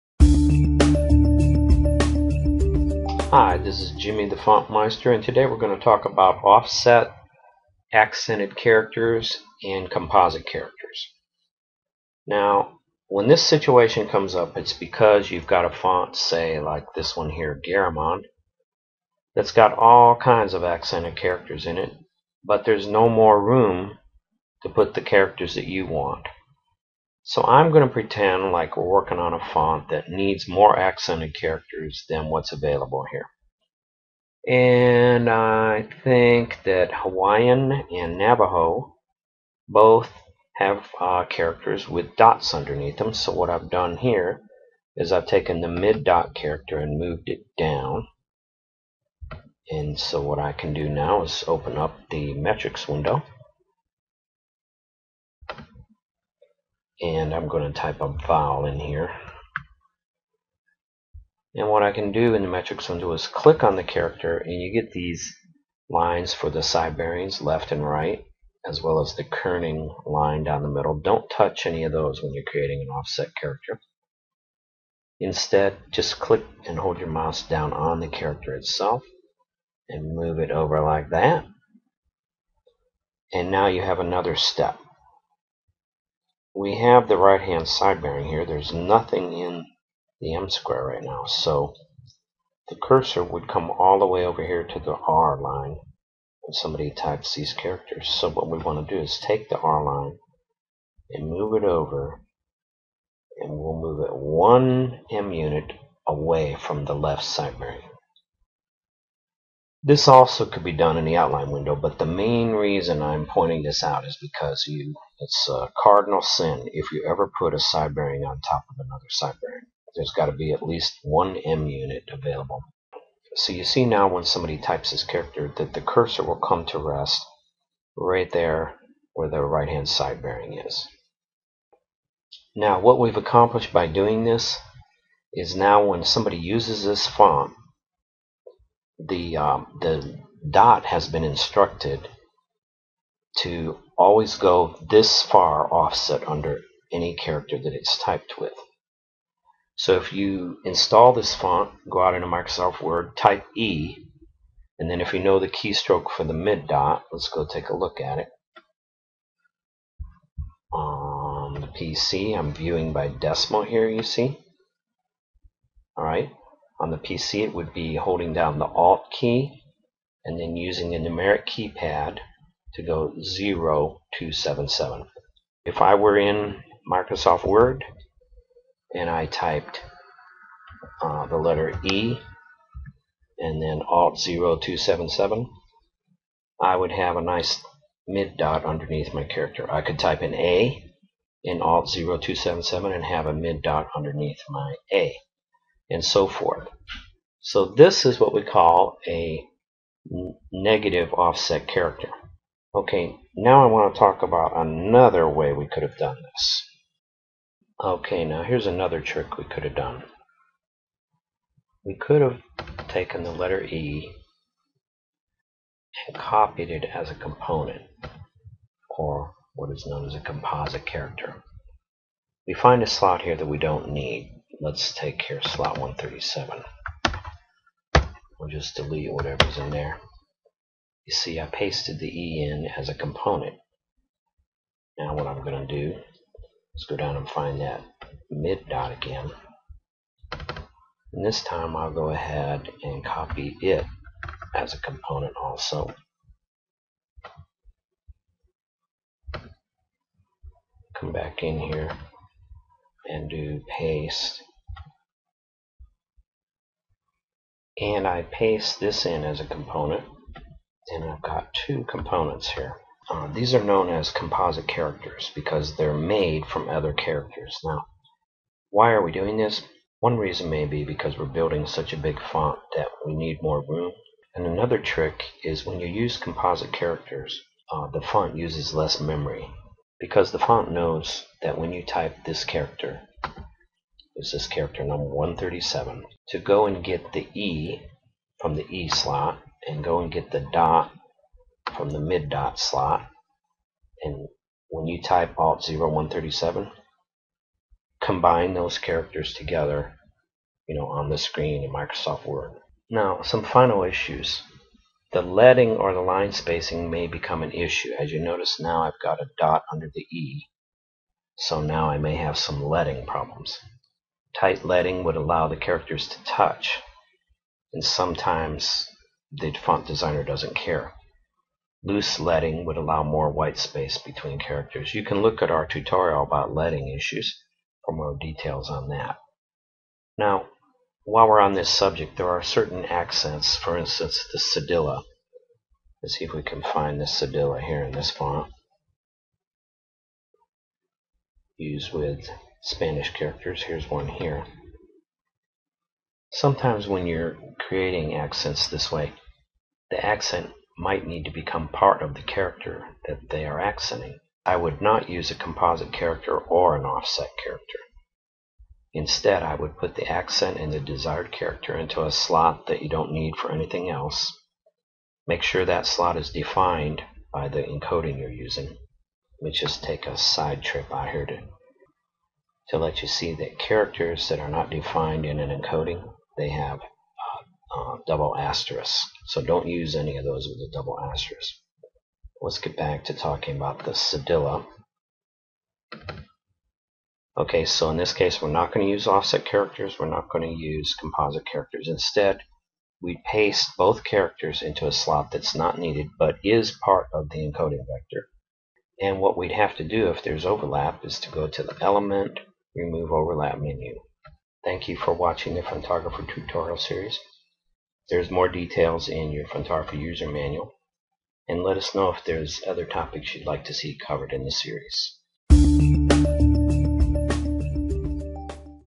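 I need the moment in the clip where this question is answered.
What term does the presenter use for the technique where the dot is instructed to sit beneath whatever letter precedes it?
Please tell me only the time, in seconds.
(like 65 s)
200 s.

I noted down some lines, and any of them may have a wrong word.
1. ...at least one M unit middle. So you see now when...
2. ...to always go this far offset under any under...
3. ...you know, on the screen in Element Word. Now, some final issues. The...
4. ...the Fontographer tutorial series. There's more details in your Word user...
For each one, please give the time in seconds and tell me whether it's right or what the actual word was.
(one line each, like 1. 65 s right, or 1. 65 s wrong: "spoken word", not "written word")
1. 120 s wrong: "available", not "middle"
2. 143 s wrong: "character", not "under"
3. 300 s wrong: "Microsoft", not "Element"
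4. 405 s wrong: "Fontographer", not "Word".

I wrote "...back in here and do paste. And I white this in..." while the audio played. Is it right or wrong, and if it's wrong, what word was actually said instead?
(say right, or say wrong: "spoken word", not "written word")
wrong: "paste", not "white".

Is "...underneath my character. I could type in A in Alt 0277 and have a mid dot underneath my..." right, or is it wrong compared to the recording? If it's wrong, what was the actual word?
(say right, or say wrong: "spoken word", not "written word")
right.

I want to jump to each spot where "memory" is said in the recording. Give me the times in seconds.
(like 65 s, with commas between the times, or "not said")
279 s.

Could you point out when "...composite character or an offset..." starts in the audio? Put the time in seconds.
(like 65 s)
355 s.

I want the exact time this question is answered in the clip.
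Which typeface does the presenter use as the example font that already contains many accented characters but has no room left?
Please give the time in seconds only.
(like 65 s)
17 s.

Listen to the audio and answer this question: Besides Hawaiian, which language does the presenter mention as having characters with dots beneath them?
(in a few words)
Navajo.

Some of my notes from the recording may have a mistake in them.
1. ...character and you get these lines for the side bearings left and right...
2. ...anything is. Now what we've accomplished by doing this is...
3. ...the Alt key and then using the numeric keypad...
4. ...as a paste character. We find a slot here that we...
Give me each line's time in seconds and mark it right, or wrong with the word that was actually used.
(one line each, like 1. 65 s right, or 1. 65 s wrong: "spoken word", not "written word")
1. 63 s right
2. 130 s wrong: "bearing", not "anything"
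3. 168 s right
4. 220 s wrong: "composite", not "paste".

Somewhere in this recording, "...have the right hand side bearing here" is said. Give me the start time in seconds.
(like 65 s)
86 s.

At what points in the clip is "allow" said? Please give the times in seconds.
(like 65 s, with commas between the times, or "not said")
315 s, 322 s.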